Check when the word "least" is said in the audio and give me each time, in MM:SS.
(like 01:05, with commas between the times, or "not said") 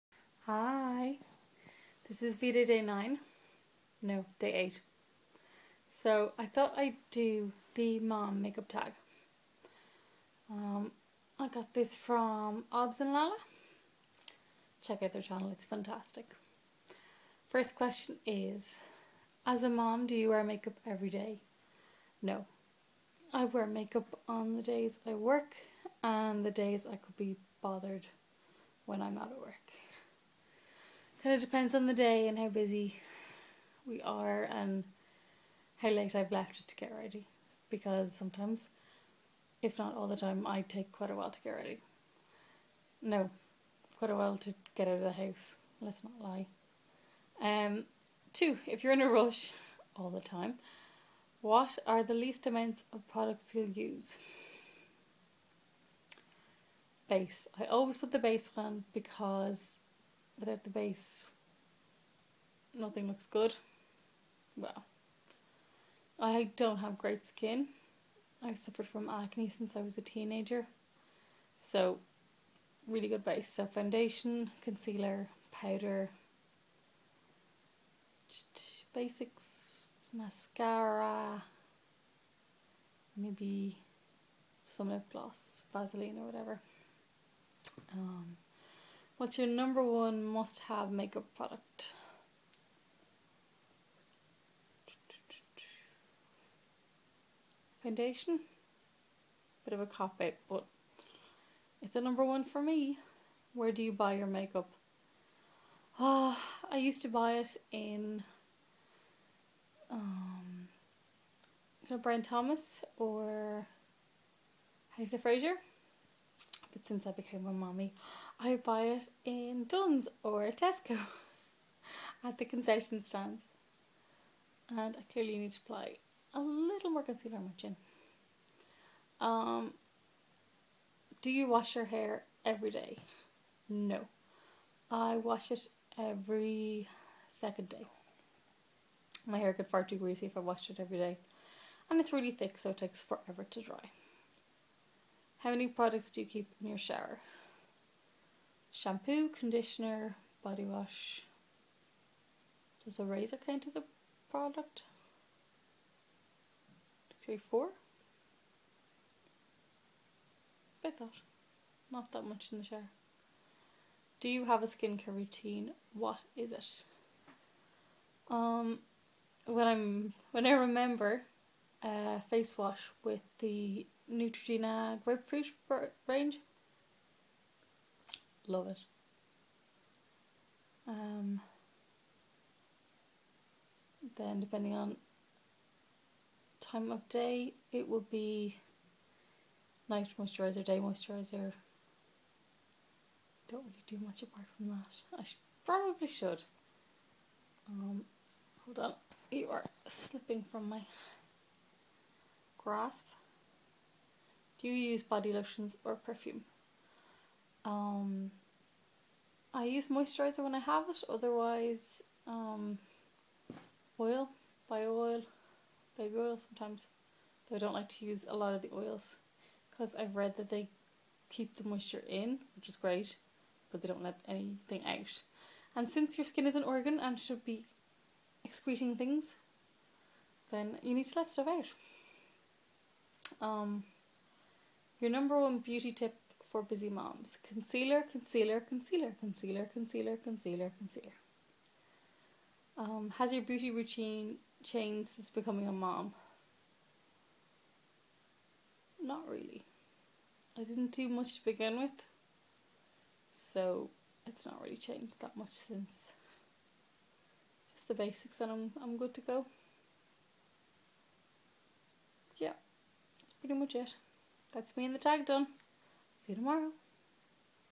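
00:52.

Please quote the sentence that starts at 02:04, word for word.
And I clearly need to apply a little more concealer on my chin.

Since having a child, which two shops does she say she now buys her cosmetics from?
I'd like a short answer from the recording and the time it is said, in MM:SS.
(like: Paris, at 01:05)
Dunnes or Tesco, at 01:59.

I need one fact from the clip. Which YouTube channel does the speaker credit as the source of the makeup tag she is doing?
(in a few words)
Obs and Lala.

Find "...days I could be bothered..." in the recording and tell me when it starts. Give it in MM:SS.
00:26.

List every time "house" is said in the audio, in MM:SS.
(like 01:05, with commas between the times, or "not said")
00:45, 01:54.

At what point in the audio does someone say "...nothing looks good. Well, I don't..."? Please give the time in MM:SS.
01:02.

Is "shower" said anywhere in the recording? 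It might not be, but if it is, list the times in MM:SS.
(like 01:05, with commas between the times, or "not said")
02:26, 02:42.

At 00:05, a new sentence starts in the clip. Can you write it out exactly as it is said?
So I thought I'd do the mom makeup tag.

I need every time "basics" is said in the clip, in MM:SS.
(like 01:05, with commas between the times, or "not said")
01:18, 04:17.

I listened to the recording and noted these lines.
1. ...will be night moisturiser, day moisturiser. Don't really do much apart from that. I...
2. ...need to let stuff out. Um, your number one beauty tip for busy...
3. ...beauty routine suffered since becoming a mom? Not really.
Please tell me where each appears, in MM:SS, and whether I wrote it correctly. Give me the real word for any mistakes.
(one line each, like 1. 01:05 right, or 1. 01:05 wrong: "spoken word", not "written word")
1. 03:07 right
2. 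03:50 right
3. 04:03 wrong: "changed", not "suffered".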